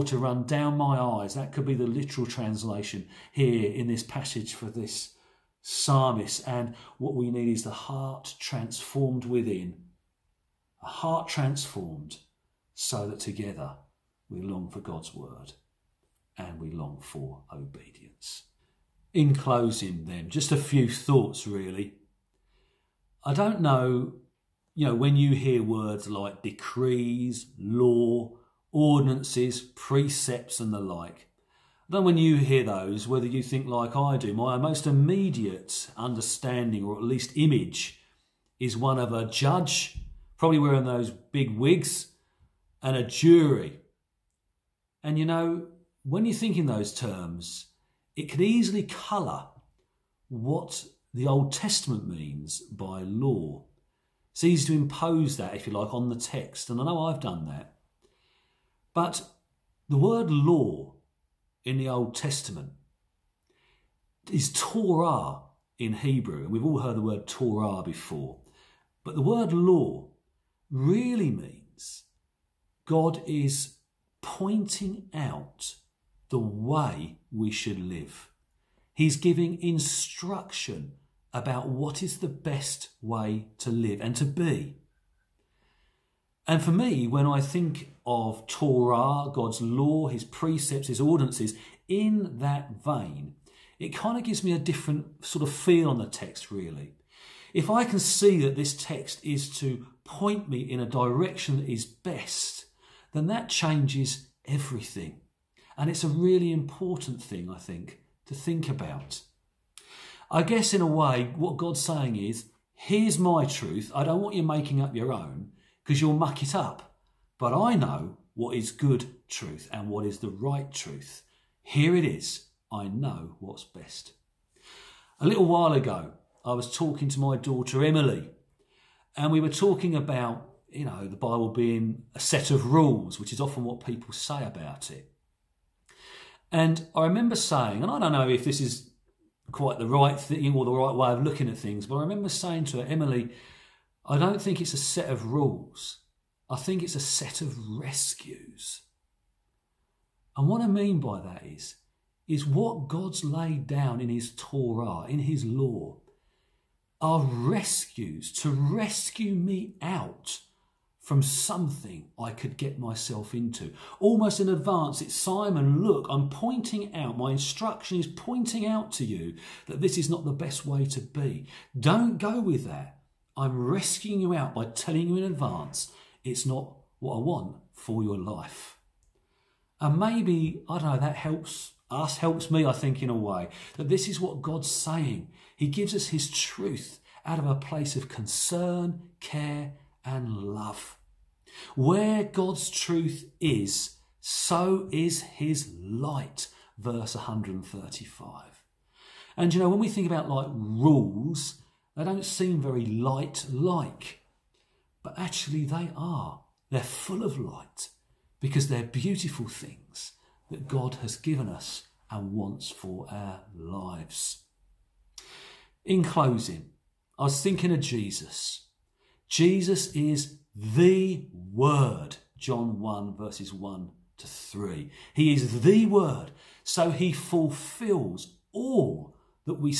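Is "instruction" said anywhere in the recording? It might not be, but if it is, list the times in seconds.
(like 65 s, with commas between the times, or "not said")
79 s, 167 s.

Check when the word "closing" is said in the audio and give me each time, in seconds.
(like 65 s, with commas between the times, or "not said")
19 s, 216 s.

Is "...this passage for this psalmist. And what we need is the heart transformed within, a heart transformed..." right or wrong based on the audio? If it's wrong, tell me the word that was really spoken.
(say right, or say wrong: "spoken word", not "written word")
right.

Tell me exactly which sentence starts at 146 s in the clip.
I think it's a set of rescues.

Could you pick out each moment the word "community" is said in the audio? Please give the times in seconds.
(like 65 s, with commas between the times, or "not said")
not said.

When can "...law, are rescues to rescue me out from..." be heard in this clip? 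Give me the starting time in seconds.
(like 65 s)
155 s.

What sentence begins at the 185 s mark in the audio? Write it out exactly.
He gives us His truth out of a place of concern, care, and love.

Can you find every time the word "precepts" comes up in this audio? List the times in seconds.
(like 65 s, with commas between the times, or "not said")
29 s, 90 s.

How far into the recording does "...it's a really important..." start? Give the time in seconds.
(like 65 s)
105 s.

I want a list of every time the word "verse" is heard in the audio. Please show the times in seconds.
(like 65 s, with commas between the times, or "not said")
196 s, 223 s.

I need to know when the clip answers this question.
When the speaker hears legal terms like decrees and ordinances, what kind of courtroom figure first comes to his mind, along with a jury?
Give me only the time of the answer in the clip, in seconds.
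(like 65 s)
39 s.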